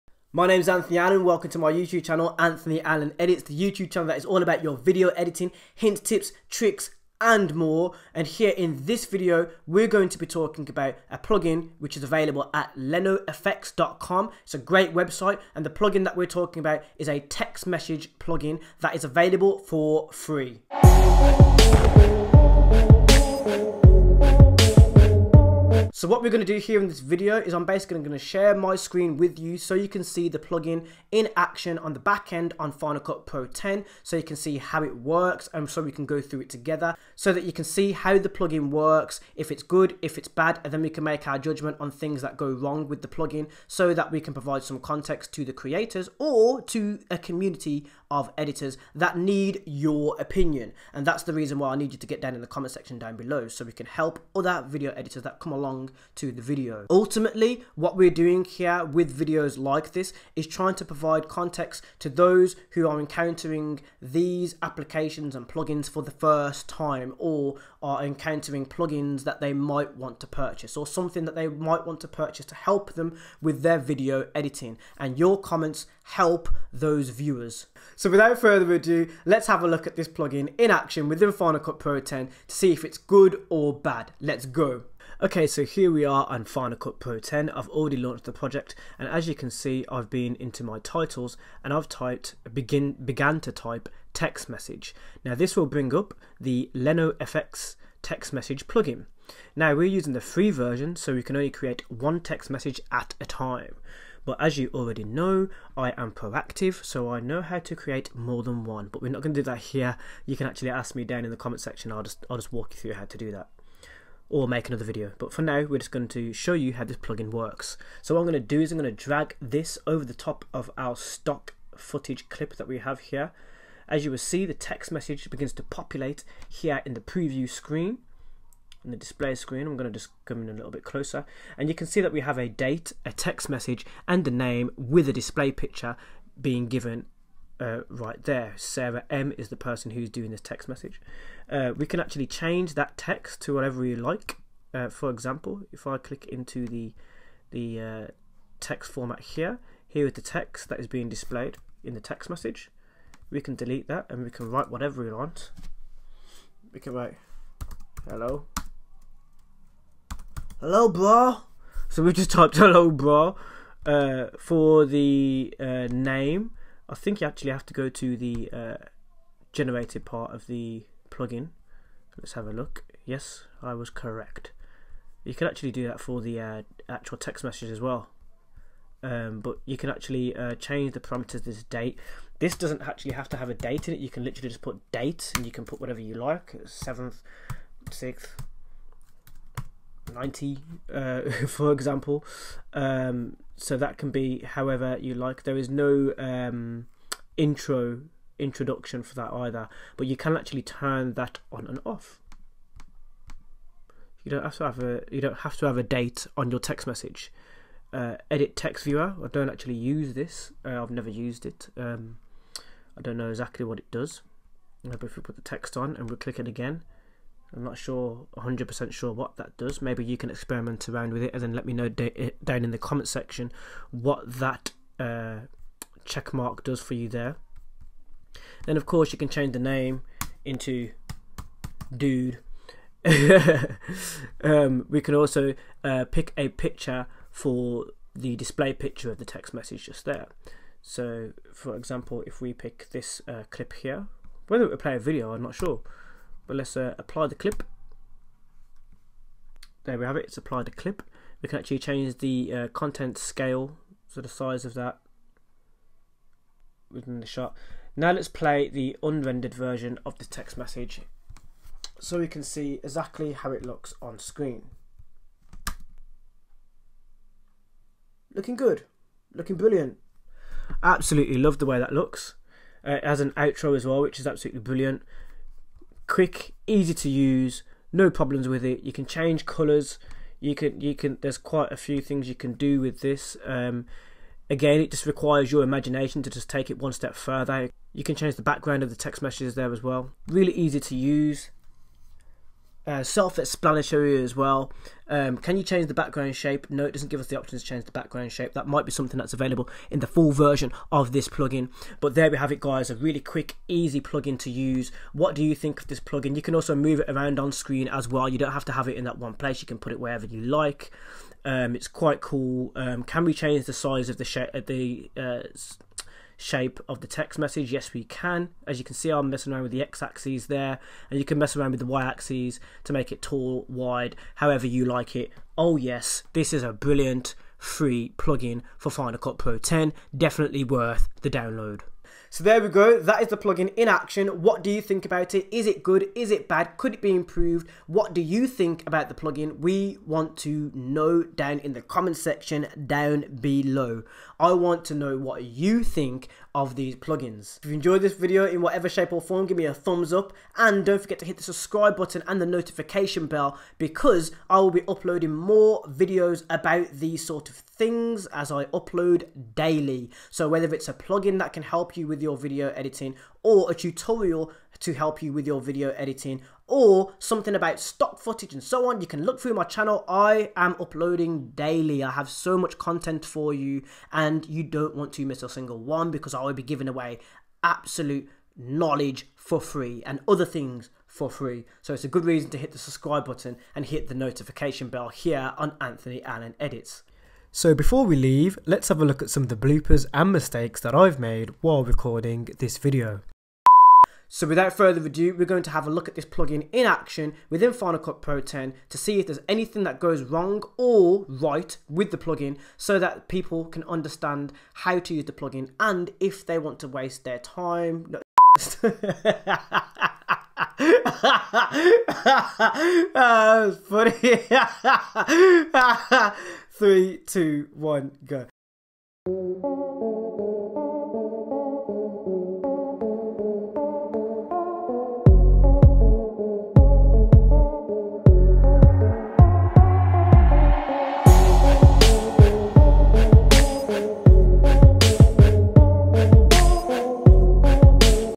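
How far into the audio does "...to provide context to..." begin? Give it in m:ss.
1:00.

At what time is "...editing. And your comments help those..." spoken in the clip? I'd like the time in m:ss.
1:14.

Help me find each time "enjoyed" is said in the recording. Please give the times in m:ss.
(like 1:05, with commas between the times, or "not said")
5:47.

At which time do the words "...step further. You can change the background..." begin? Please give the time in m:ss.
4:46.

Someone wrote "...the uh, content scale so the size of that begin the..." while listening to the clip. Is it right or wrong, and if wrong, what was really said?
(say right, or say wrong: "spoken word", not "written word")
wrong: "within", not "begin".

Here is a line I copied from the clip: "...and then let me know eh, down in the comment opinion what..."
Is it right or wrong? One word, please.
wrong.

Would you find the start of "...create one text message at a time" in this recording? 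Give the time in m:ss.
1:41.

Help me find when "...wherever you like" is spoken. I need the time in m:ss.
5:09.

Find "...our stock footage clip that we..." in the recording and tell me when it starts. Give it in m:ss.
2:00.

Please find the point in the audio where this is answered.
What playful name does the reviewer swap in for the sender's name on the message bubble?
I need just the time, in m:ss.
3:51.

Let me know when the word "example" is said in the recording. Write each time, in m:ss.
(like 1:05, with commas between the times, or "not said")
2:25, 3:11, 4:01.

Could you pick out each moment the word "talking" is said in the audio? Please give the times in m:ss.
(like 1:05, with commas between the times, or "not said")
0:10, 0:16.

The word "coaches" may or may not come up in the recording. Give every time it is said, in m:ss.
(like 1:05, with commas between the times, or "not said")
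not said.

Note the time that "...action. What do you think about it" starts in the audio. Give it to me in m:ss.
5:33.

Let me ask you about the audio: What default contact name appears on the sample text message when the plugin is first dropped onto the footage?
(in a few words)
Sarah M.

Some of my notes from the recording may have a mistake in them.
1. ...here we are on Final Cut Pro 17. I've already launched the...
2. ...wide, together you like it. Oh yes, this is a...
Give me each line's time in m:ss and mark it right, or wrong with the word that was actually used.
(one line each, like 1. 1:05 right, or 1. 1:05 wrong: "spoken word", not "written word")
1. 1:25 wrong: "10", not "17"
2. 5:23 wrong: "however", not "together".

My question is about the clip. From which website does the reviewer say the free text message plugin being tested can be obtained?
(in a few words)
lenofx.com.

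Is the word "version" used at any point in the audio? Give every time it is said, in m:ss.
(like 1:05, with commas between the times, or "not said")
1:40, 4:19, 5:00.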